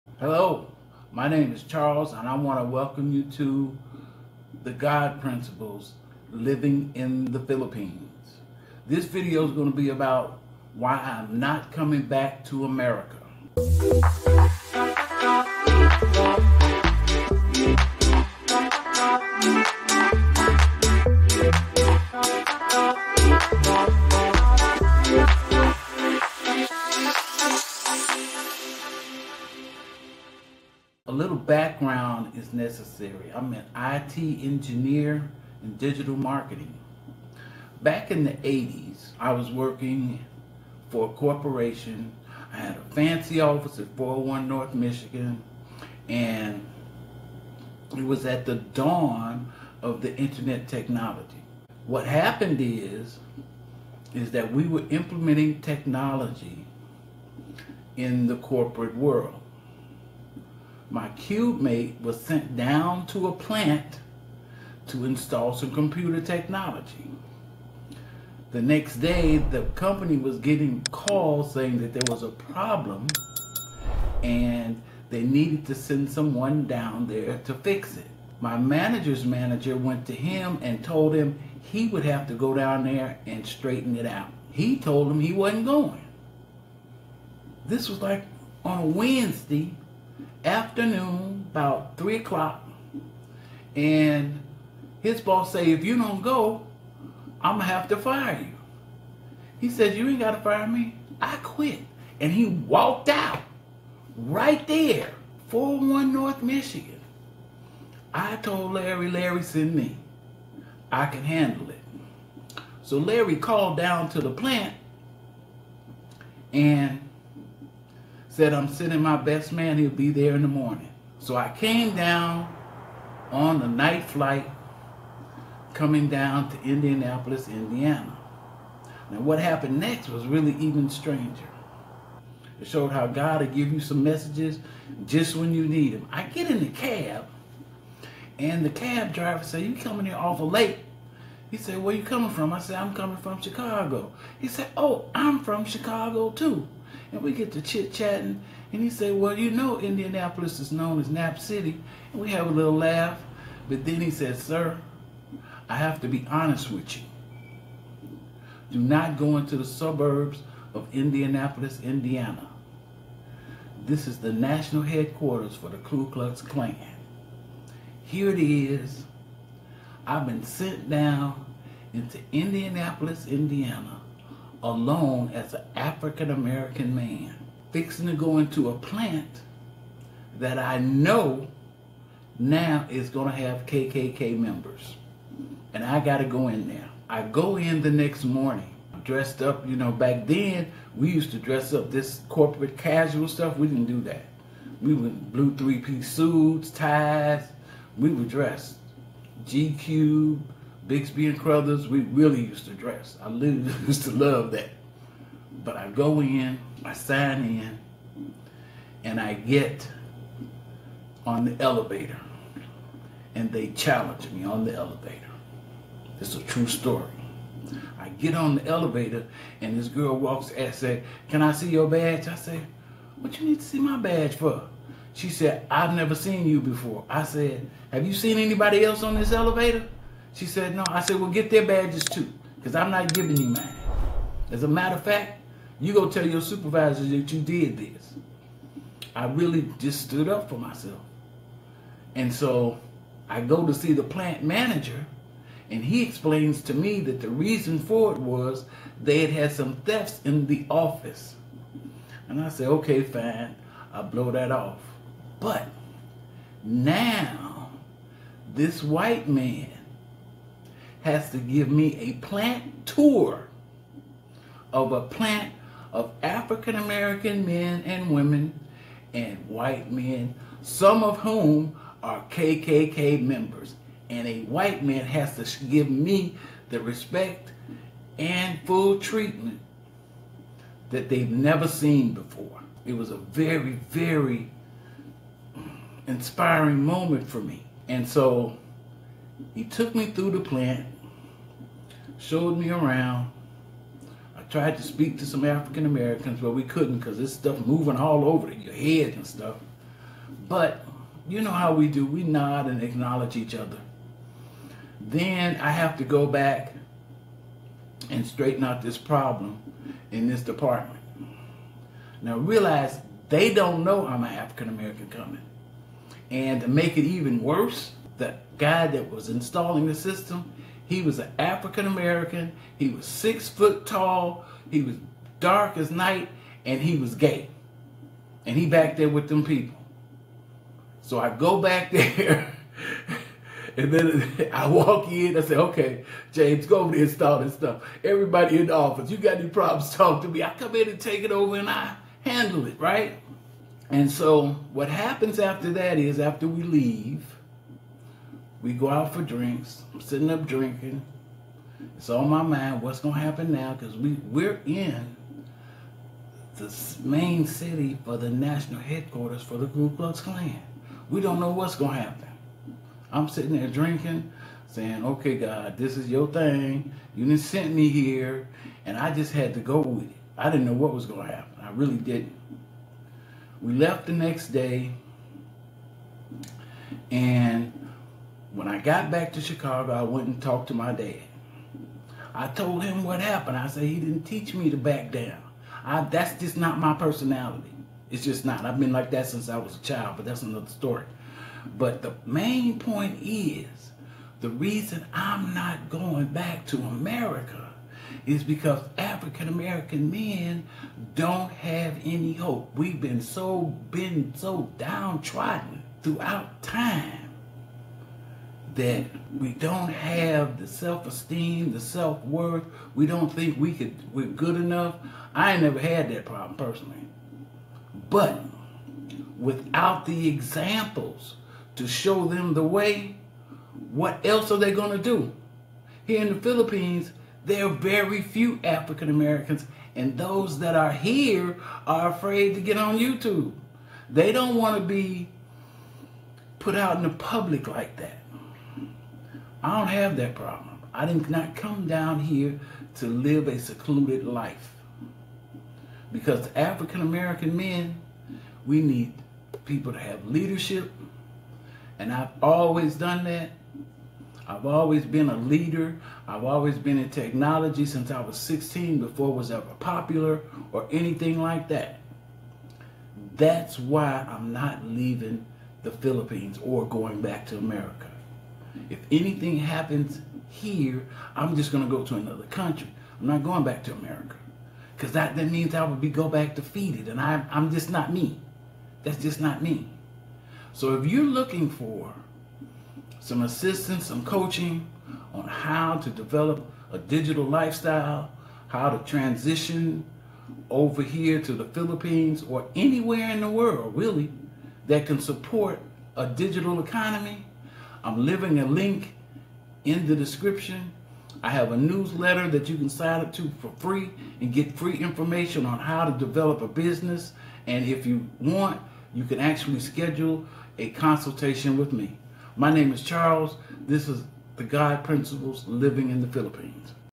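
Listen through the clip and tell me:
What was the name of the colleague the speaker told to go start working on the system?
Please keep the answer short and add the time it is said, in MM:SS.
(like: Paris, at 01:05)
James, at 05:36.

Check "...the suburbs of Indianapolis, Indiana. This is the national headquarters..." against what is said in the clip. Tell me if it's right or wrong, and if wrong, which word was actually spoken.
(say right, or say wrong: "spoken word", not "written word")
right.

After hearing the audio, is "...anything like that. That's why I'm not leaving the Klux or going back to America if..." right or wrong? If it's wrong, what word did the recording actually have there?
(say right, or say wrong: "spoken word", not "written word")
wrong: "Philippines", not "Klux".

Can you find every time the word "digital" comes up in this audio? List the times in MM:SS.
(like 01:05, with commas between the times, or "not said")
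00:35, 08:06, 08:16.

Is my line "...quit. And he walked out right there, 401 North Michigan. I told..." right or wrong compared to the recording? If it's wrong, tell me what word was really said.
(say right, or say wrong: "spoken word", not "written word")
right.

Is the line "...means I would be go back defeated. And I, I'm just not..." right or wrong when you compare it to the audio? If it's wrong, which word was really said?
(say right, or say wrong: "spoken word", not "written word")
right.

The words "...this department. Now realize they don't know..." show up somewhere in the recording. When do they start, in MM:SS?
05:10.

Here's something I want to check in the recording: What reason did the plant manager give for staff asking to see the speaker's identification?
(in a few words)
thefts in the office.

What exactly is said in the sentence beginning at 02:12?
It showed how God will give you some messages just when you need them.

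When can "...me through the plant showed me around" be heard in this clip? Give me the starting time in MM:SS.
04:49.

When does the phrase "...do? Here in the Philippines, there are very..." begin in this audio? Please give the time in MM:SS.
07:05.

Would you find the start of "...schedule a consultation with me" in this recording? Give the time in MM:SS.
08:29.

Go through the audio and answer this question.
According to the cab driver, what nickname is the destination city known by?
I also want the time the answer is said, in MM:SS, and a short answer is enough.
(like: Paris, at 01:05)
Nap City, at 02:31.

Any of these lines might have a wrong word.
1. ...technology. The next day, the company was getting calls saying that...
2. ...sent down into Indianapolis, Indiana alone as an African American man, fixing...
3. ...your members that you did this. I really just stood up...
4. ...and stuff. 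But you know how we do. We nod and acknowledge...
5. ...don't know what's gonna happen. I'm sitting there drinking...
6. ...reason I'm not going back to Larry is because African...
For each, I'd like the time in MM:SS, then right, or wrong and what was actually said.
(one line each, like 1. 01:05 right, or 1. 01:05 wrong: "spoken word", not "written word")
1. 01:06 right
2. 02:50 right
3. 03:56 wrong: "supervisors", not "members"
4. 04:59 right
5. 06:01 right
6. 06:34 wrong: "America", not "Larry".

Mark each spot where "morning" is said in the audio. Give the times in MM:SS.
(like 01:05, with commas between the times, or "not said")
02:00, 03:08.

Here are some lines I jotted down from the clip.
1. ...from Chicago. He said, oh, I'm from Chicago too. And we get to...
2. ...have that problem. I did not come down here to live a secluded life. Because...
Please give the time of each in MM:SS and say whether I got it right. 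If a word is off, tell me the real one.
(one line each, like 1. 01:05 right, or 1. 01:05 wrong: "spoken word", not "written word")
1. 02:23 right
2. 07:19 right.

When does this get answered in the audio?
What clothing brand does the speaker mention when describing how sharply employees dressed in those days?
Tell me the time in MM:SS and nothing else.
03:20.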